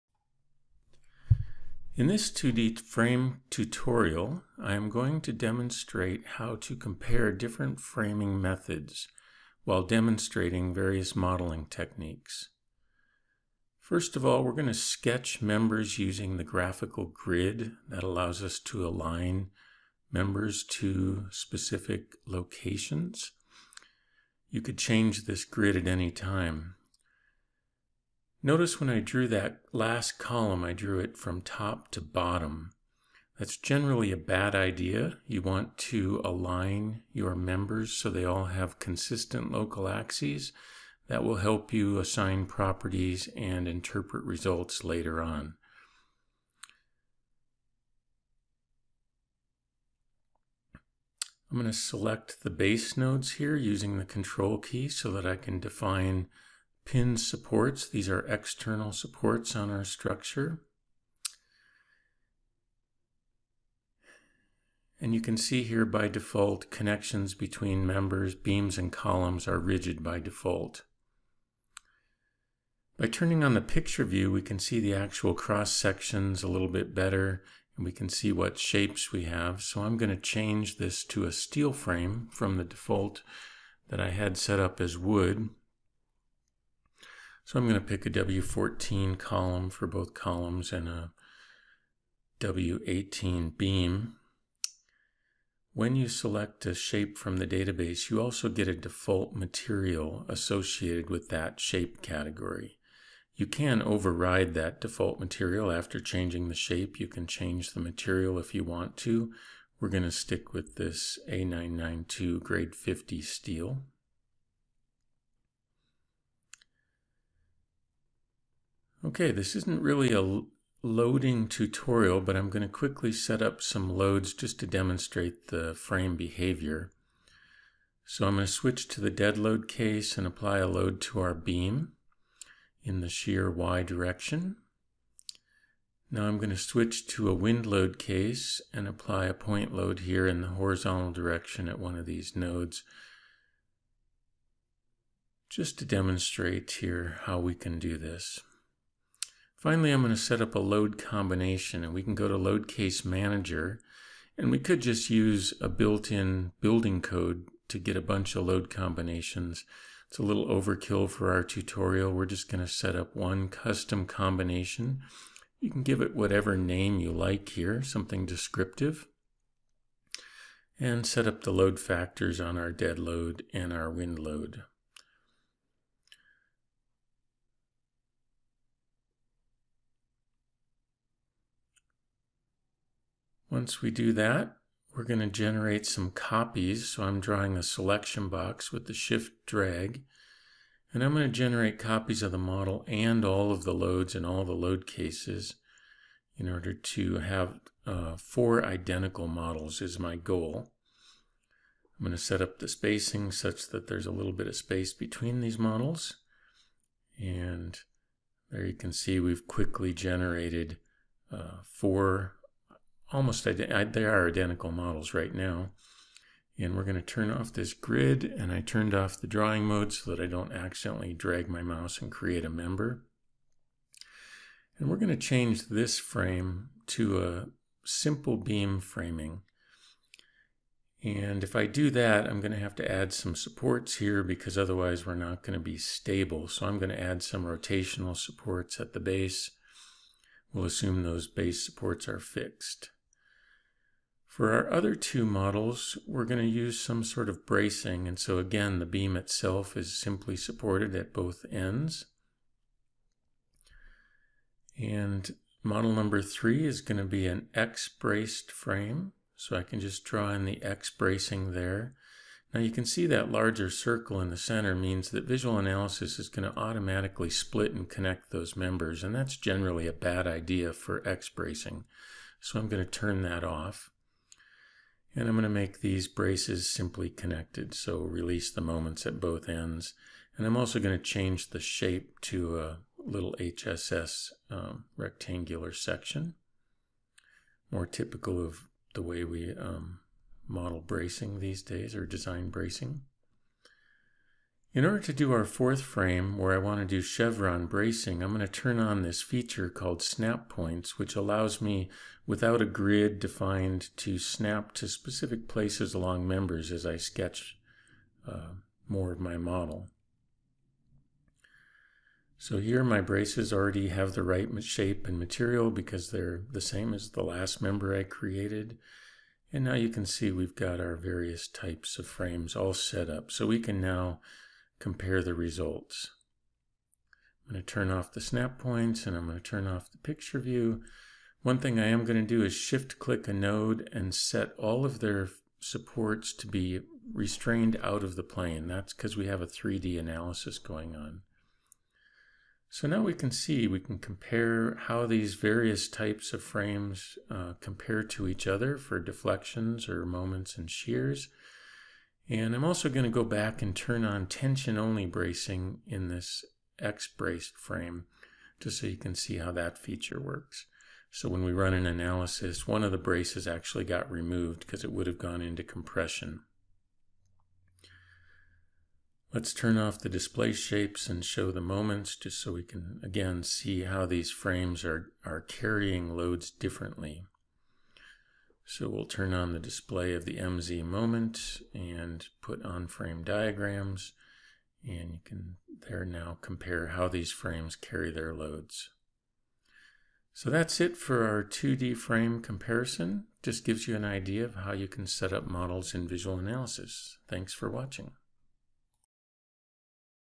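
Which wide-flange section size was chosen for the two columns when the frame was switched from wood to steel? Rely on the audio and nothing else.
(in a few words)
W14.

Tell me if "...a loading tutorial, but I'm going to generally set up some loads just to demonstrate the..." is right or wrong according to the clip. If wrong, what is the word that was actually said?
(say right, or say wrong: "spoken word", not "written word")
wrong: "quickly", not "generally".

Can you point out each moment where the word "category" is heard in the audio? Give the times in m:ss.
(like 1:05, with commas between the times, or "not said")
1:42.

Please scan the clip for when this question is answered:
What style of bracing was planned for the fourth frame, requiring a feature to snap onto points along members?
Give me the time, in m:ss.
4:57.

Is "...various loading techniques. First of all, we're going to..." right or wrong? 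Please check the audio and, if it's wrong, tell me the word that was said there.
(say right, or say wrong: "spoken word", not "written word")
wrong: "modeling", not "loading".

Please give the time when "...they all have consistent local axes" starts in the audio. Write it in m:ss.
0:38.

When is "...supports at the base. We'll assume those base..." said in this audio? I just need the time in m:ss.
3:58.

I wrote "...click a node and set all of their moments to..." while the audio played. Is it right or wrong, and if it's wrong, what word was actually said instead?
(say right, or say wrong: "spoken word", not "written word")
wrong: "supports", not "moments".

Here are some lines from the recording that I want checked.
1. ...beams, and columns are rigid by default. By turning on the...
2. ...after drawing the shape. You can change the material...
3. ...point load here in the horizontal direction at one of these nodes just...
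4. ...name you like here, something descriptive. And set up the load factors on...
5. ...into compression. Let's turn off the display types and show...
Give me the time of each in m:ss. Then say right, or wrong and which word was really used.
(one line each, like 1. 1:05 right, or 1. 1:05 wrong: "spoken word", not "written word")
1. 1:08 right
2. 1:45 wrong: "changing", not "drawing"
3. 2:19 right
4. 2:46 right
5. 6:05 wrong: "shapes", not "types".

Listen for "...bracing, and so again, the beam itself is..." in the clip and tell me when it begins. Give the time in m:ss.
4:07.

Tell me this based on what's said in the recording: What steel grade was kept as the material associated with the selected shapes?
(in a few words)
A992 grade 50.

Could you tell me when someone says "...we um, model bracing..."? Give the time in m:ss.
4:49.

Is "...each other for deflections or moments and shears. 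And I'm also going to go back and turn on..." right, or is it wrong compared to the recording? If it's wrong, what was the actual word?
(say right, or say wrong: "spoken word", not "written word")
right.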